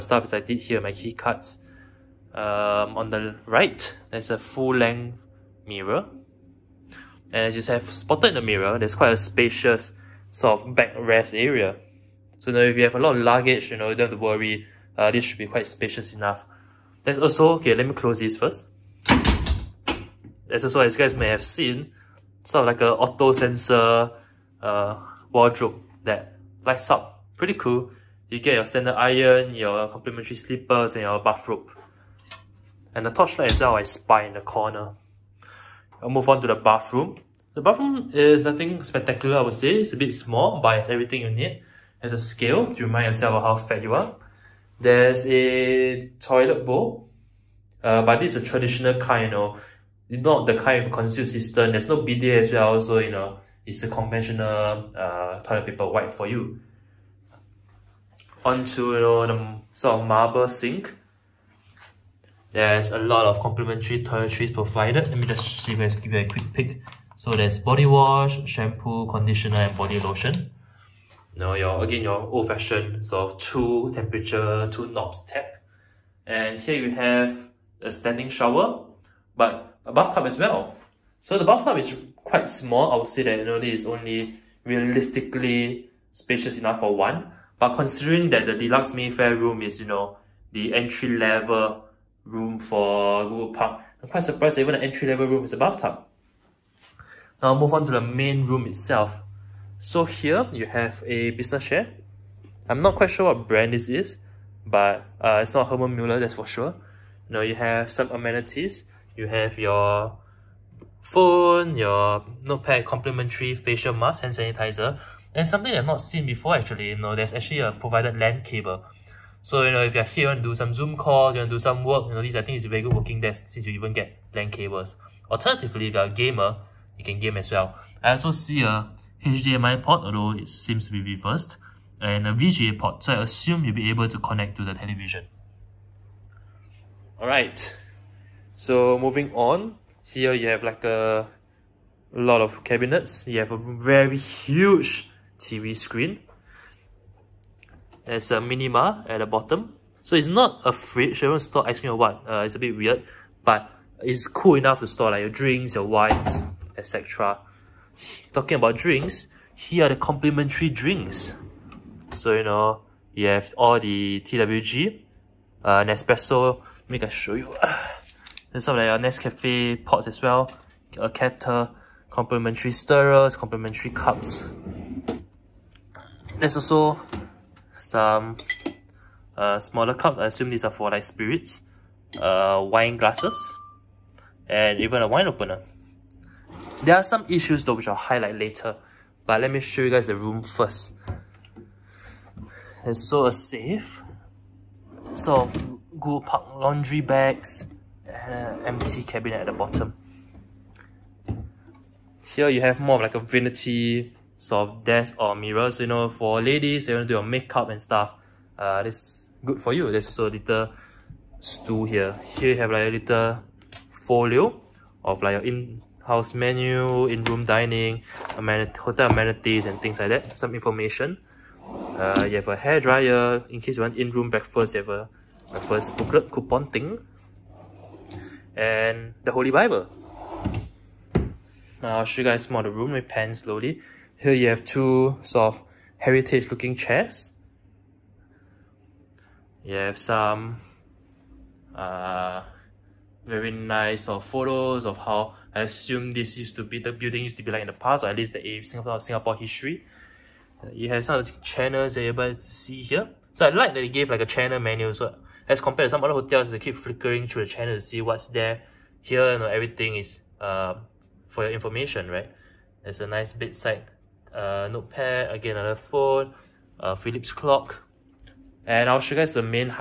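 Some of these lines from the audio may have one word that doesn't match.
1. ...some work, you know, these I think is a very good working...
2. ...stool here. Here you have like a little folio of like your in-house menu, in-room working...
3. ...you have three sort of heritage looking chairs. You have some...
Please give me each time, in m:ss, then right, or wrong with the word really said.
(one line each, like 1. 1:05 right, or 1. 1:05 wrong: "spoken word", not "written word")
1. 2:01 right
2. 3:31 wrong: "dining", not "working"
3. 3:54 wrong: "two", not "three".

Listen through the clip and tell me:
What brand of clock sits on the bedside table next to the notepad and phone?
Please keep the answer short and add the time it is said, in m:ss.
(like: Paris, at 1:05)
Philips, at 4:26.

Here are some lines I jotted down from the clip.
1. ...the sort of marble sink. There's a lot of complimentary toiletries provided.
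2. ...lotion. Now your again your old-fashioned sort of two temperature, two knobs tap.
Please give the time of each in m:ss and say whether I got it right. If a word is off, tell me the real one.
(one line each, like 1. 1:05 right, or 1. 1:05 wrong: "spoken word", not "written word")
1. 0:58 right
2. 1:09 right.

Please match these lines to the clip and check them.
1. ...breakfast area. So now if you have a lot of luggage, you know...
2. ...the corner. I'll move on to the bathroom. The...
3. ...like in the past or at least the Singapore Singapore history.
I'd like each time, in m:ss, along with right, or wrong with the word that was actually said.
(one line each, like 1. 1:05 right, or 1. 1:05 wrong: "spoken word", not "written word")
1. 0:10 wrong: "backrest", not "breakfast"
2. 0:34 right
3. 4:07 right.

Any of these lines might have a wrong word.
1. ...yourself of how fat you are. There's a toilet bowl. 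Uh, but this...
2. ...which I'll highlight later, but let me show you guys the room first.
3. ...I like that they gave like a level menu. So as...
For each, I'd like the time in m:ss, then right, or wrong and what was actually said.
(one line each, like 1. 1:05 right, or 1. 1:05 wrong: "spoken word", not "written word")
1. 0:43 right
2. 3:07 right
3. 4:13 wrong: "channel", not "level".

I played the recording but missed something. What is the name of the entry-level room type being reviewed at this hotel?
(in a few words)
Deluxe Mayfair.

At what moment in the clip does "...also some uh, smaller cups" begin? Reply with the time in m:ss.
2:56.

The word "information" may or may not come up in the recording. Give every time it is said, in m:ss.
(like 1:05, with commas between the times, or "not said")
3:40, 4:21.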